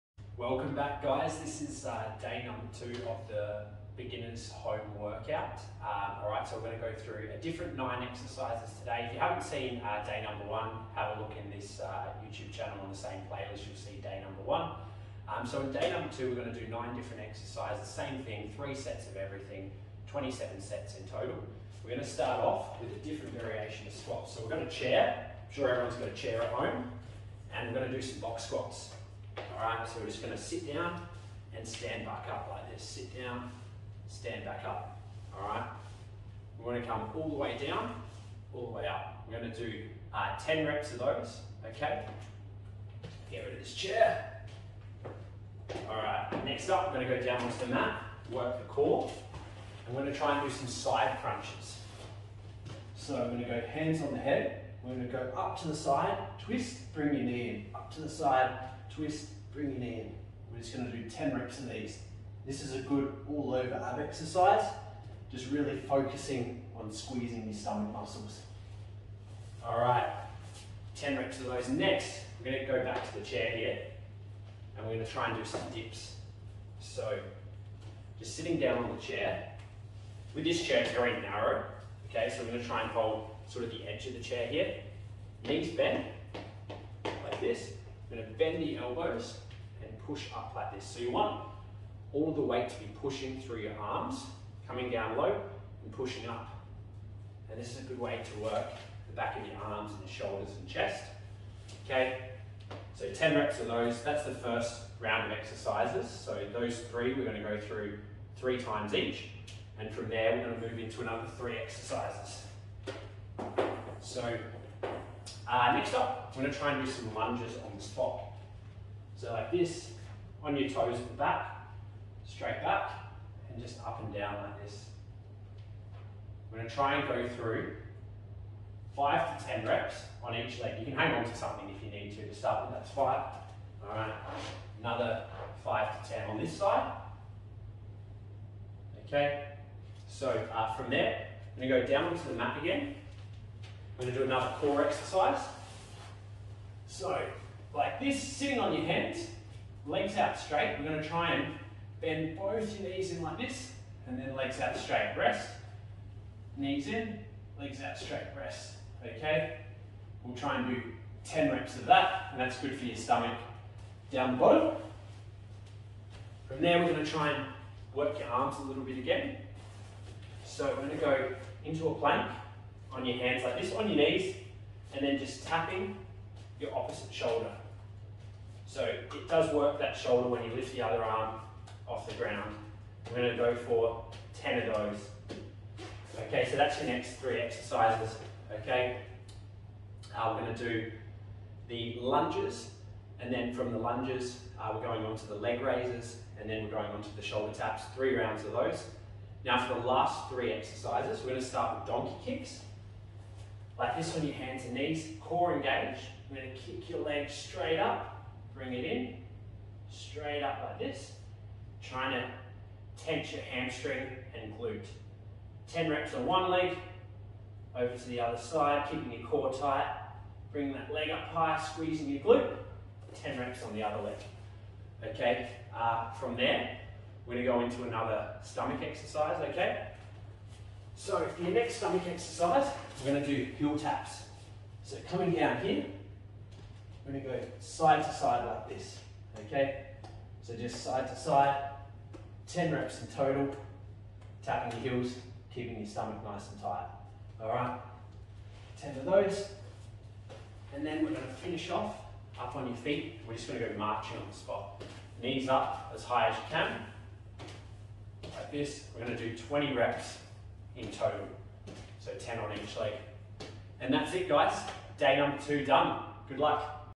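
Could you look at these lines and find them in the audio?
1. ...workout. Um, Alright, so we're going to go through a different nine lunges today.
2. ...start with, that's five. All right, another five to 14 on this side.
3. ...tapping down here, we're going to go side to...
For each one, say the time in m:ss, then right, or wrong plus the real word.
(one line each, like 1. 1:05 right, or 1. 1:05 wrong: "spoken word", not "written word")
1. 0:04 wrong: "exercises", not "lunges"
2. 2:12 wrong: "10", not "14"
3. 3:55 wrong: "coming", not "tapping".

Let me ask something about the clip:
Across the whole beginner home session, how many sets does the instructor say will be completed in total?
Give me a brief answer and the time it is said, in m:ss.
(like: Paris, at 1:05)
27, at 0:20.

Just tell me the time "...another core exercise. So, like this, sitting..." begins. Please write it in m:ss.
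2:24.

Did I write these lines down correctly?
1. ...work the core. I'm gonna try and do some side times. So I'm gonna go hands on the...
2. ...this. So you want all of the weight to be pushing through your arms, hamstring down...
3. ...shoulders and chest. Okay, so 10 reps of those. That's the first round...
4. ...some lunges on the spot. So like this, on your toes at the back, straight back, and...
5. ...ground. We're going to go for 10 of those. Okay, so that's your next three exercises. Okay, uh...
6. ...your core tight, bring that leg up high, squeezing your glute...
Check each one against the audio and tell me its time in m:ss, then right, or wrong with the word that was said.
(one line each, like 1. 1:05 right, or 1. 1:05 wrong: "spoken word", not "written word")
1. 0:48 wrong: "crunches", not "times"
2. 1:30 wrong: "coming", not "hamstring"
3. 1:40 right
4. 1:56 right
5. 3:02 right
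6. 3:39 right.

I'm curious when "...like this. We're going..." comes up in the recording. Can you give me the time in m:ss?
4:18.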